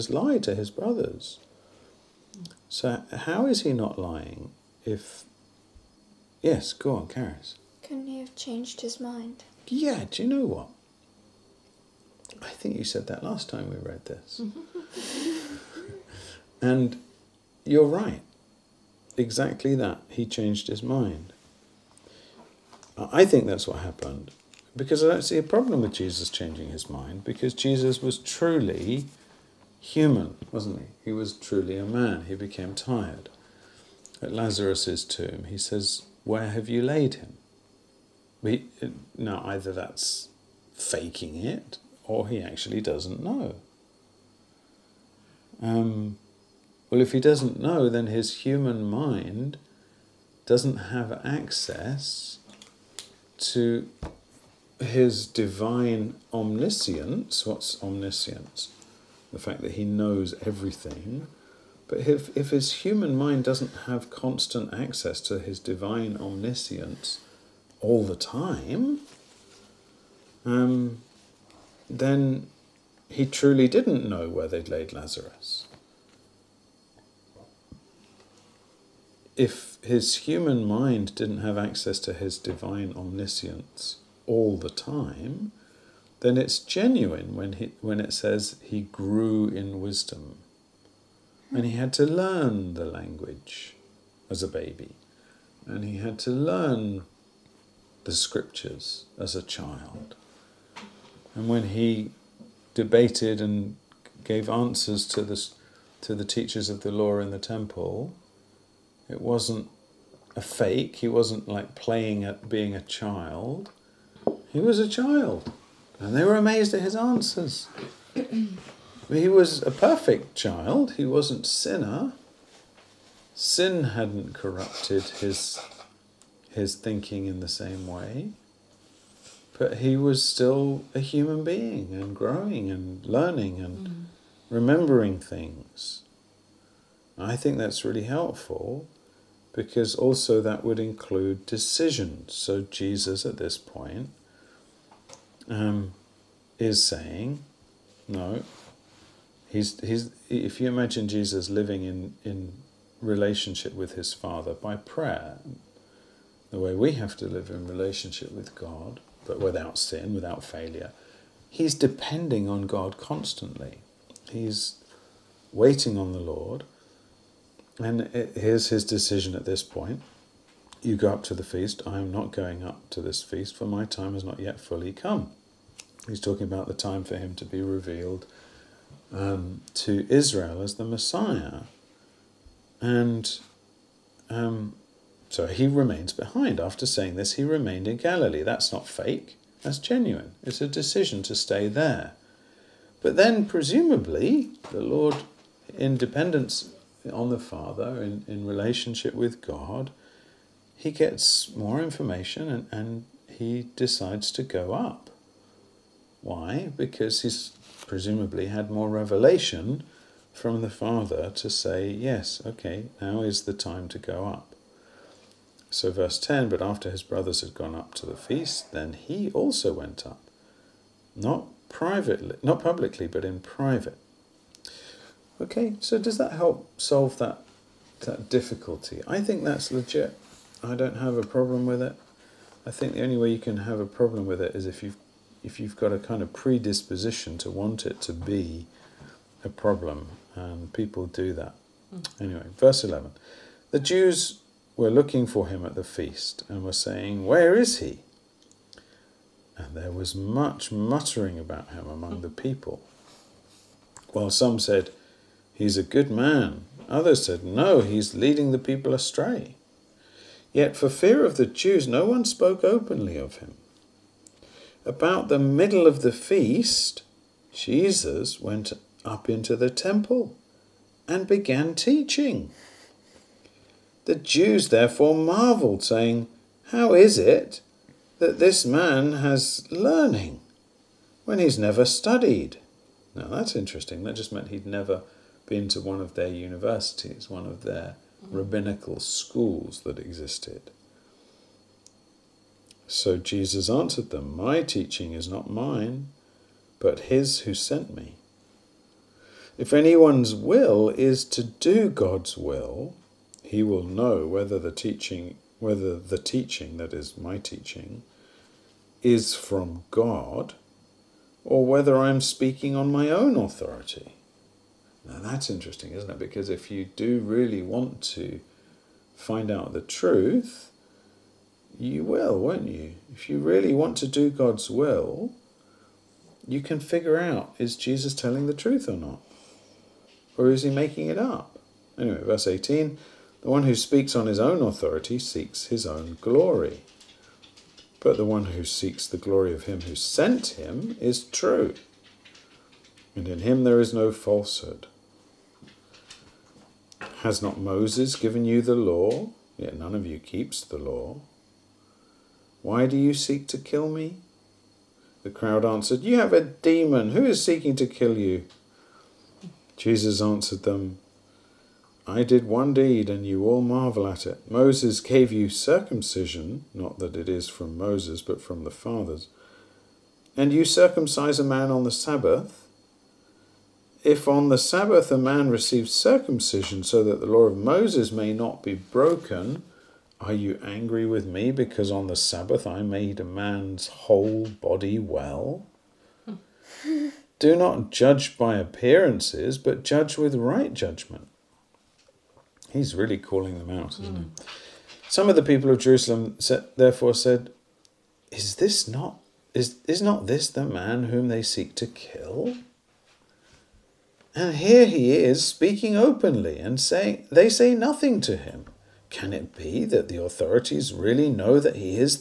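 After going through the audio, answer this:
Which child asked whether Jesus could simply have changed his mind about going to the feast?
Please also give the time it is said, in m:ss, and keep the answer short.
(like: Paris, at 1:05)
Karis, at 0:07.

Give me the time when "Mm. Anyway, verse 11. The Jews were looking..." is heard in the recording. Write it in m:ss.
4:01.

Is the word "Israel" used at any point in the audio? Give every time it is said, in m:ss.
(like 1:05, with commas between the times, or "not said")
3:00.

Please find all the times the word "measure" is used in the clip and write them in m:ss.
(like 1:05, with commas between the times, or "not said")
not said.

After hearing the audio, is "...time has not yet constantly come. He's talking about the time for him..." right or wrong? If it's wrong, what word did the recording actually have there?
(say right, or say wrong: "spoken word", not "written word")
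wrong: "fully", not "constantly".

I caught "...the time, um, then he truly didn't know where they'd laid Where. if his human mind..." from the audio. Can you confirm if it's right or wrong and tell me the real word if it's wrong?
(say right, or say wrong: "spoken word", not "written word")
wrong: "Lazarus", not "Where".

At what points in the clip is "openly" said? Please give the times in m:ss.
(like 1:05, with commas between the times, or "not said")
4:22, 6:45.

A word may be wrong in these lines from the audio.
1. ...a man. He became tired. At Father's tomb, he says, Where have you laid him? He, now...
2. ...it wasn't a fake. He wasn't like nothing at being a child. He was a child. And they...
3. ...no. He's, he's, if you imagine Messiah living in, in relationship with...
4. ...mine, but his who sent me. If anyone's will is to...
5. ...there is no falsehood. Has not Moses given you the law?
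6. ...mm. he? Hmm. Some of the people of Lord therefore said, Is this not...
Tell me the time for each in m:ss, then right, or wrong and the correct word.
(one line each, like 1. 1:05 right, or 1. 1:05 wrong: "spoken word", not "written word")
1. 0:31 wrong: "Lazarus", not "Father"
2. 1:49 wrong: "playing", not "nothing"
3. 2:28 wrong: "Jesus", not "Messiah"
4. 4:55 right
5. 5:43 right
6. 6:34 wrong: "Jerusalem", not "Lord".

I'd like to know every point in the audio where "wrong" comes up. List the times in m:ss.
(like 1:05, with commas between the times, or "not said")
not said.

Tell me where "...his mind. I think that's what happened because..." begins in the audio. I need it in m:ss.
0:20.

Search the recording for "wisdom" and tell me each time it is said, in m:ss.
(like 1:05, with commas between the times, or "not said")
1:29.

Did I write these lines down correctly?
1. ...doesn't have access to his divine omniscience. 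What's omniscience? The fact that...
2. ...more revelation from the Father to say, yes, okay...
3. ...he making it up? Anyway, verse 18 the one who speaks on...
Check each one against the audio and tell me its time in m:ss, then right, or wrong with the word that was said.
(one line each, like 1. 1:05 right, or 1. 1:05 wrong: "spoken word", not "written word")
1. 0:50 right
2. 3:28 right
3. 5:30 right.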